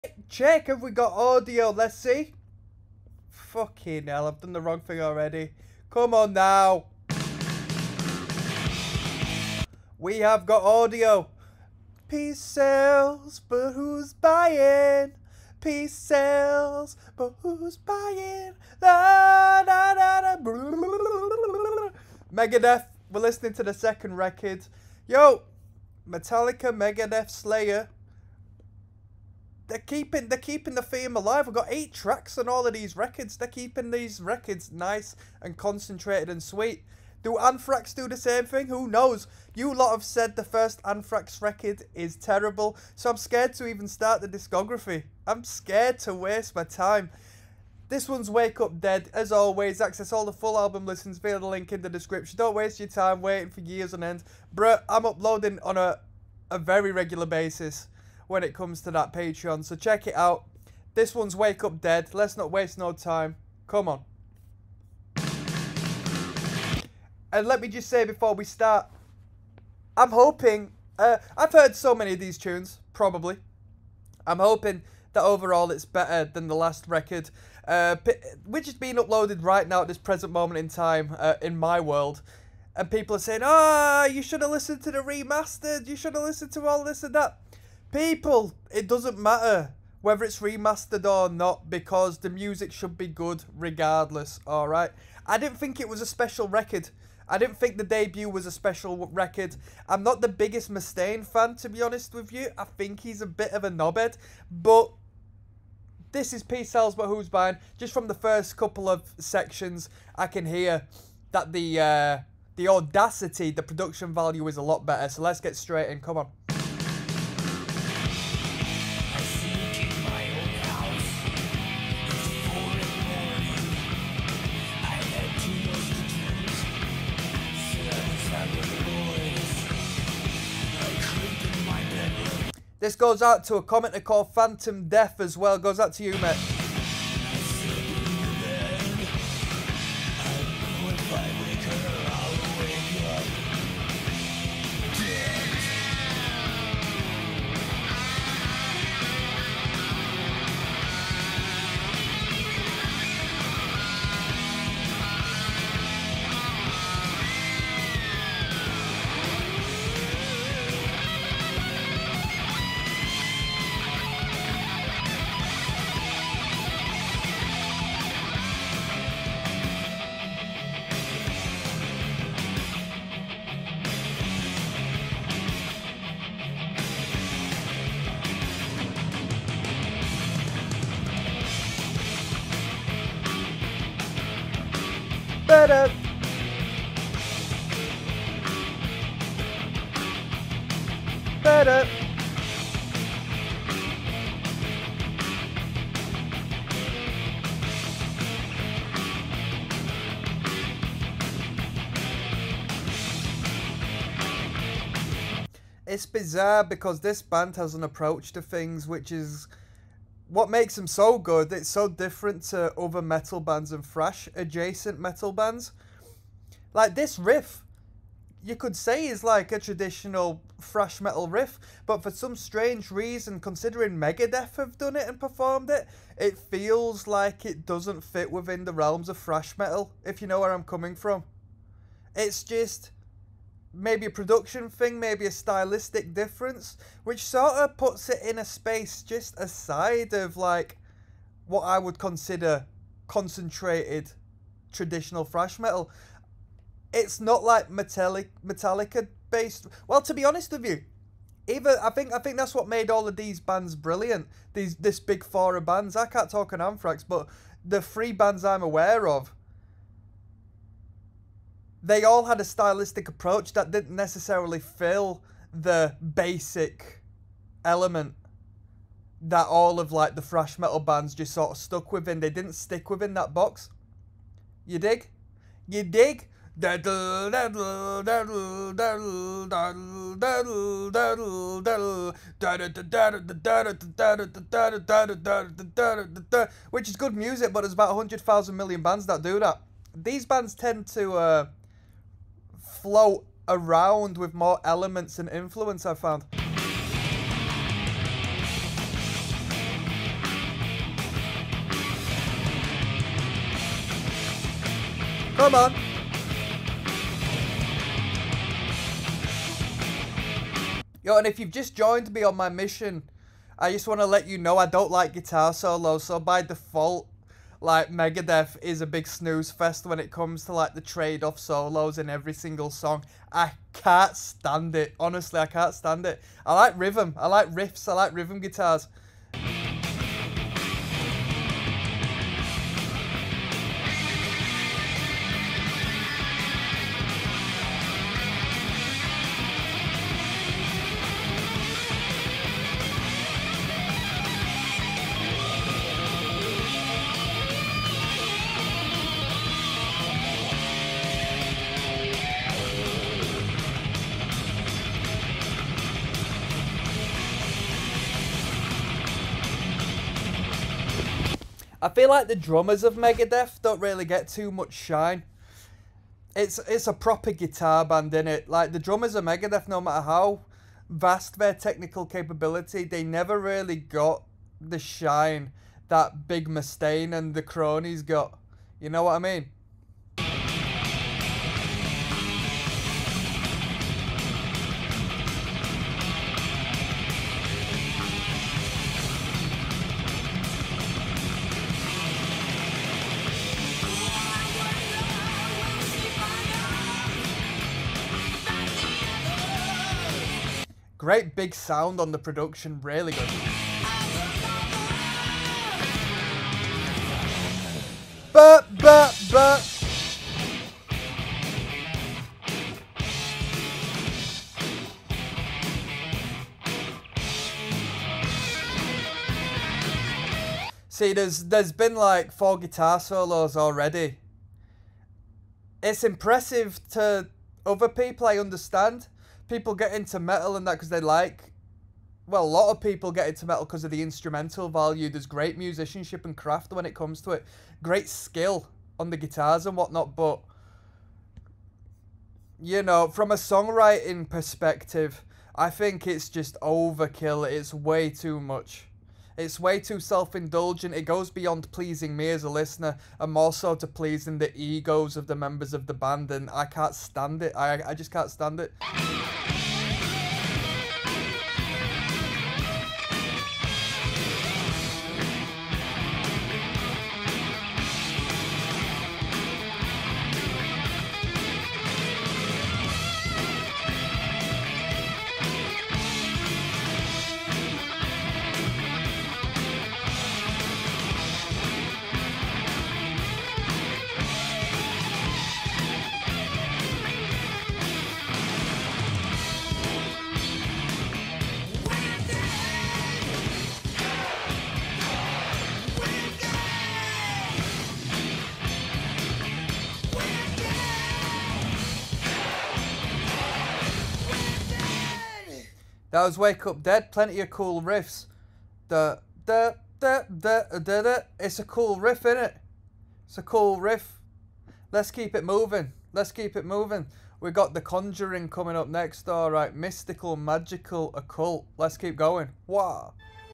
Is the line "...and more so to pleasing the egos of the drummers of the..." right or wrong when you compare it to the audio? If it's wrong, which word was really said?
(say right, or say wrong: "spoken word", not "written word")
wrong: "members", not "drummers".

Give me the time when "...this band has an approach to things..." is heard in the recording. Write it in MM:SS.
03:27.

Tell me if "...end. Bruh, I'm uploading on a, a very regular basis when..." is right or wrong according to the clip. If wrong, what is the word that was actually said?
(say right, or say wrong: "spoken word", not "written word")
right.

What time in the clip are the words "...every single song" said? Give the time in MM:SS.
05:22.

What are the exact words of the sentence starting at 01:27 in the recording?
People, it doesn't matter whether it's remastered or not because the music should be good regardless, alright?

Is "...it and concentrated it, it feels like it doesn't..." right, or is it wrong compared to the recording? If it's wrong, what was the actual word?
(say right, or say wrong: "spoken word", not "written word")
wrong: "performed", not "concentrated".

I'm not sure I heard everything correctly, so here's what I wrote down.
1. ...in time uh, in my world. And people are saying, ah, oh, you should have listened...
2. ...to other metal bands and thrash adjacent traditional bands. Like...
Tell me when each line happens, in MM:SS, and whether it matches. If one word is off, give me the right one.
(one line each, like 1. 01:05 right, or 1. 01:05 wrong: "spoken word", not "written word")
1. 01:20 right
2. 03:32 wrong: "metal", not "traditional".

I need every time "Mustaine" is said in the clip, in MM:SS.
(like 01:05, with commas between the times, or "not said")
01:40, 06:16.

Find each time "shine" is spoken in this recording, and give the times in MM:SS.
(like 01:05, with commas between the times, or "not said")
06:04, 06:14.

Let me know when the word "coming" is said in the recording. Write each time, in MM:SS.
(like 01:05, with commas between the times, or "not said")
03:50, 08:38.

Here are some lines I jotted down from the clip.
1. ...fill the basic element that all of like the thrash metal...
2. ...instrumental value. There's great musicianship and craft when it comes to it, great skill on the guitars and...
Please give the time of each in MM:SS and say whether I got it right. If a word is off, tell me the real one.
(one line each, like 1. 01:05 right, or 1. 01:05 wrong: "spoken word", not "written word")
1. 04:24 right
2. 07:14 right.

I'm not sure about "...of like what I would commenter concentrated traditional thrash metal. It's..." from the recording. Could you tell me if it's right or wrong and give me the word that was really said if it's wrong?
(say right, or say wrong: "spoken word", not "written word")
wrong: "consider", not "commenter".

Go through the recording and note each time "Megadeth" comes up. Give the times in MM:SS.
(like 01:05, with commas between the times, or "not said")
00:22, 00:26, 03:43, 05:17, 06:02, 06:09.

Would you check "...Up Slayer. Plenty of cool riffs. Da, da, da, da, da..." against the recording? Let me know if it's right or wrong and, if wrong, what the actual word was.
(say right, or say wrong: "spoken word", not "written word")
wrong: "Dead", not "Slayer".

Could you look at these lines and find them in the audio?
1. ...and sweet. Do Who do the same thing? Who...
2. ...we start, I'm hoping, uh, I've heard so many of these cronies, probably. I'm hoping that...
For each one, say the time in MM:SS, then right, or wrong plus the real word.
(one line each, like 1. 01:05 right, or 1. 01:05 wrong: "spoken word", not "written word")
1. 00:36 wrong: "Anthrax", not "Who"
2. 01:08 wrong: "tunes", not "cronies".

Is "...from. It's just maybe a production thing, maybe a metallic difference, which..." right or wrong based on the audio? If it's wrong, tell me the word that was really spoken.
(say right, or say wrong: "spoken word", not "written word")
wrong: "stylistic", not "metallic".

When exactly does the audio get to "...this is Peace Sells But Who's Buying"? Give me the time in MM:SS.
01:46.